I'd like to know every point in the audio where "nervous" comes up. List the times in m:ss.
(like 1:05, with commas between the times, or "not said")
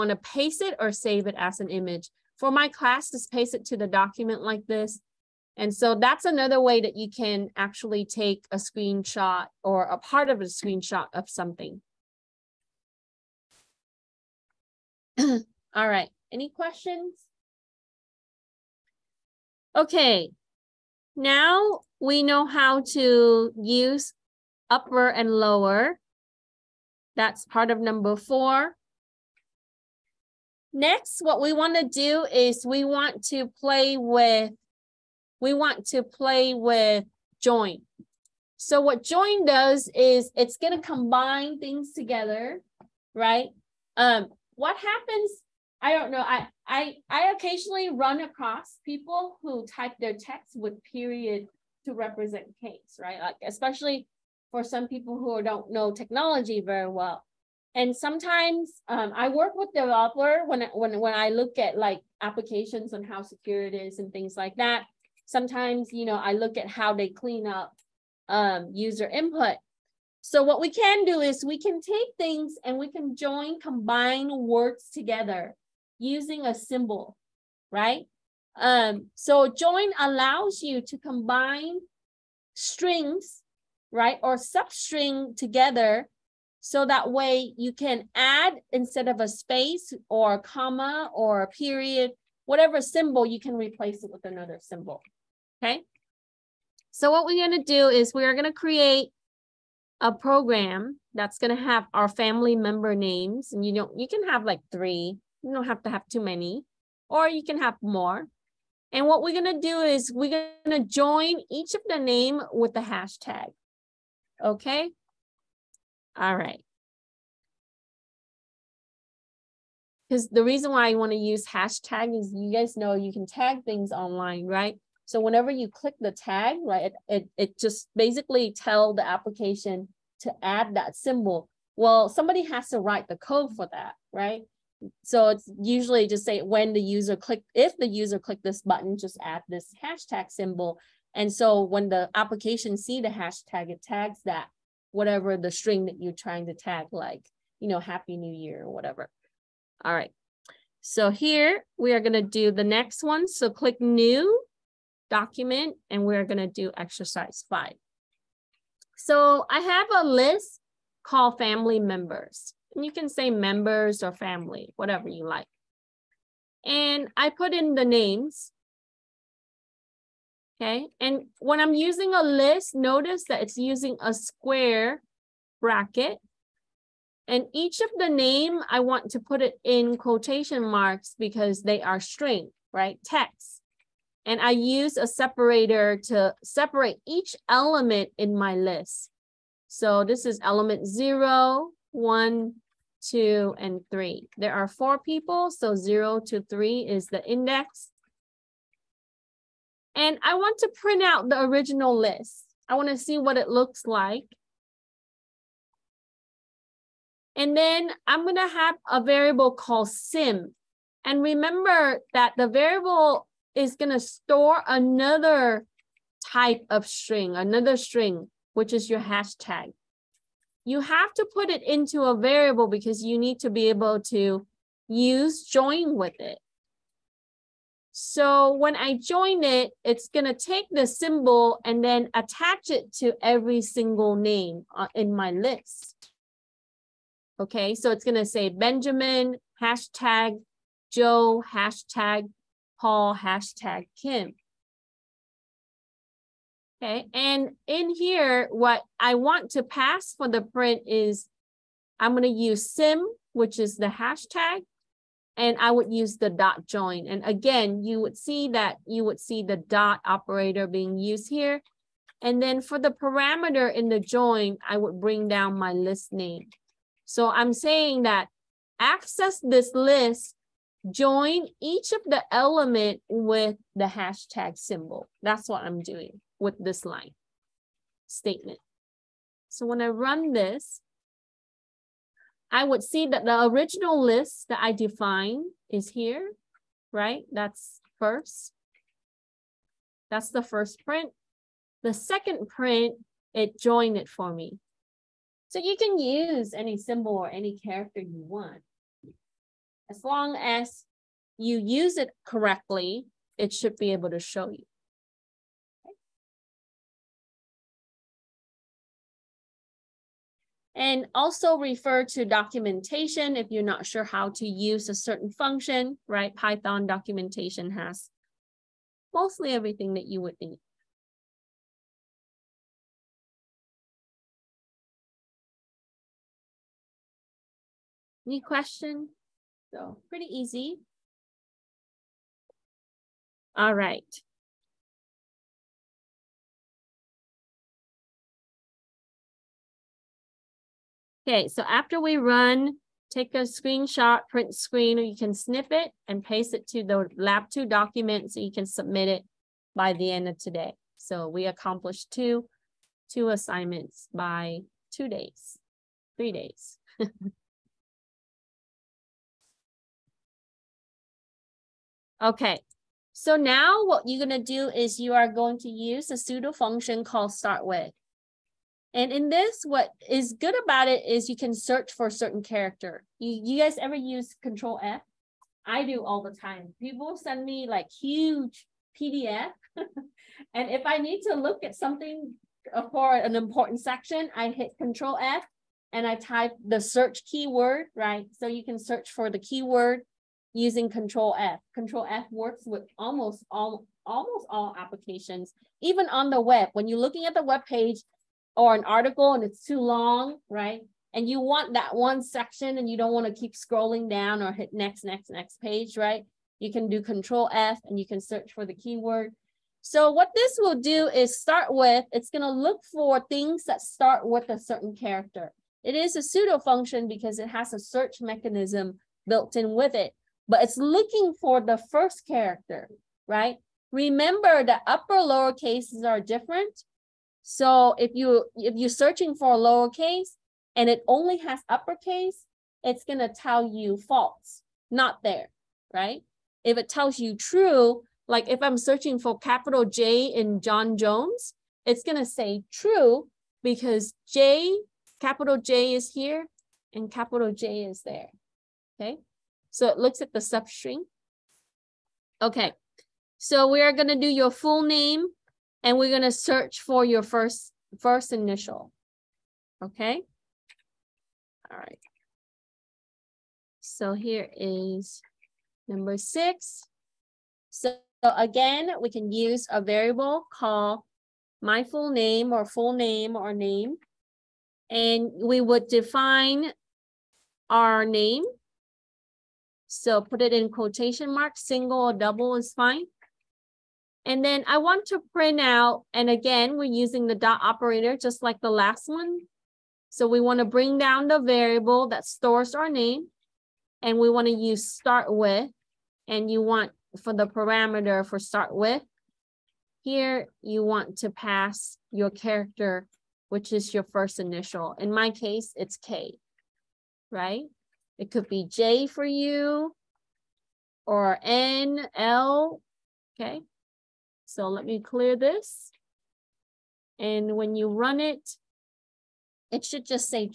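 not said.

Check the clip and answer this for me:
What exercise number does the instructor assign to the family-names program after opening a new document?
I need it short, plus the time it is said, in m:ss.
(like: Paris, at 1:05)
5, at 2:36.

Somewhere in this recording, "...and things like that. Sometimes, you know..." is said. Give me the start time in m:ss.
1:03.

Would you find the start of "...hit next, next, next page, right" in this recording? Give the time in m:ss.
6:44.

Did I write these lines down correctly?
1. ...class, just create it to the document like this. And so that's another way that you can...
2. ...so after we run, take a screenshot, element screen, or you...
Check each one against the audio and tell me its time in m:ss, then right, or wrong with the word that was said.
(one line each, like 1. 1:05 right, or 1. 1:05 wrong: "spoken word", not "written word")
1. 0:02 wrong: "paste", not "create"
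2. 5:41 wrong: "print", not "element".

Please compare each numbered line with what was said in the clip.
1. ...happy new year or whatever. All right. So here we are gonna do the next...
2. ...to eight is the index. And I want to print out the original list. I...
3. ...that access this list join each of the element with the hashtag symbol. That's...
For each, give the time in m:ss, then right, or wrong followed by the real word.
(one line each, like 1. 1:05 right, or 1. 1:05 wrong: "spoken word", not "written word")
1. 2:27 right
2. 3:16 wrong: "three", not "eight"
3. 4:28 right.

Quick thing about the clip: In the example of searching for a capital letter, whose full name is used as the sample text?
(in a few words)
John Jones.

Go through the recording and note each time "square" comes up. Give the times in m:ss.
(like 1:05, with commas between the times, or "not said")
2:54.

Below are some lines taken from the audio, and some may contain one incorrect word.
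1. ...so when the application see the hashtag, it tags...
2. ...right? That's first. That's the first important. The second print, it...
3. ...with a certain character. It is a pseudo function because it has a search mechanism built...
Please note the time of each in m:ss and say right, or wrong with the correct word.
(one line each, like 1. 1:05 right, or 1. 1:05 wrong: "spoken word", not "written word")
1. 2:21 right
2. 4:46 wrong: "print", not "important"
3. 6:54 right.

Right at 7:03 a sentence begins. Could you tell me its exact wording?
Remember the upper lower cases are different.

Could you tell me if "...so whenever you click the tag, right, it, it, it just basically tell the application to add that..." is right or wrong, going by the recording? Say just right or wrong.
right.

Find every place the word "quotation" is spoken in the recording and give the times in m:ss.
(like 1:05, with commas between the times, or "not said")
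2:59, 8:00.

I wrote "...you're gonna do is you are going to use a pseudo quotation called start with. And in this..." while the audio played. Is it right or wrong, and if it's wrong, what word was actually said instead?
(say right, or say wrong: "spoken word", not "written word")
wrong: "function", not "quotation".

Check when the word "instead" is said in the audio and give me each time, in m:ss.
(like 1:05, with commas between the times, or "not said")
1:28.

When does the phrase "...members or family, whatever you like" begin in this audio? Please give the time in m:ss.
2:43.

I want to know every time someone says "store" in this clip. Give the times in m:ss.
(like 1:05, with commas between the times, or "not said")
3:33, 8:12.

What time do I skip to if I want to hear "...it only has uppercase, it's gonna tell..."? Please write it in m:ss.
7:10.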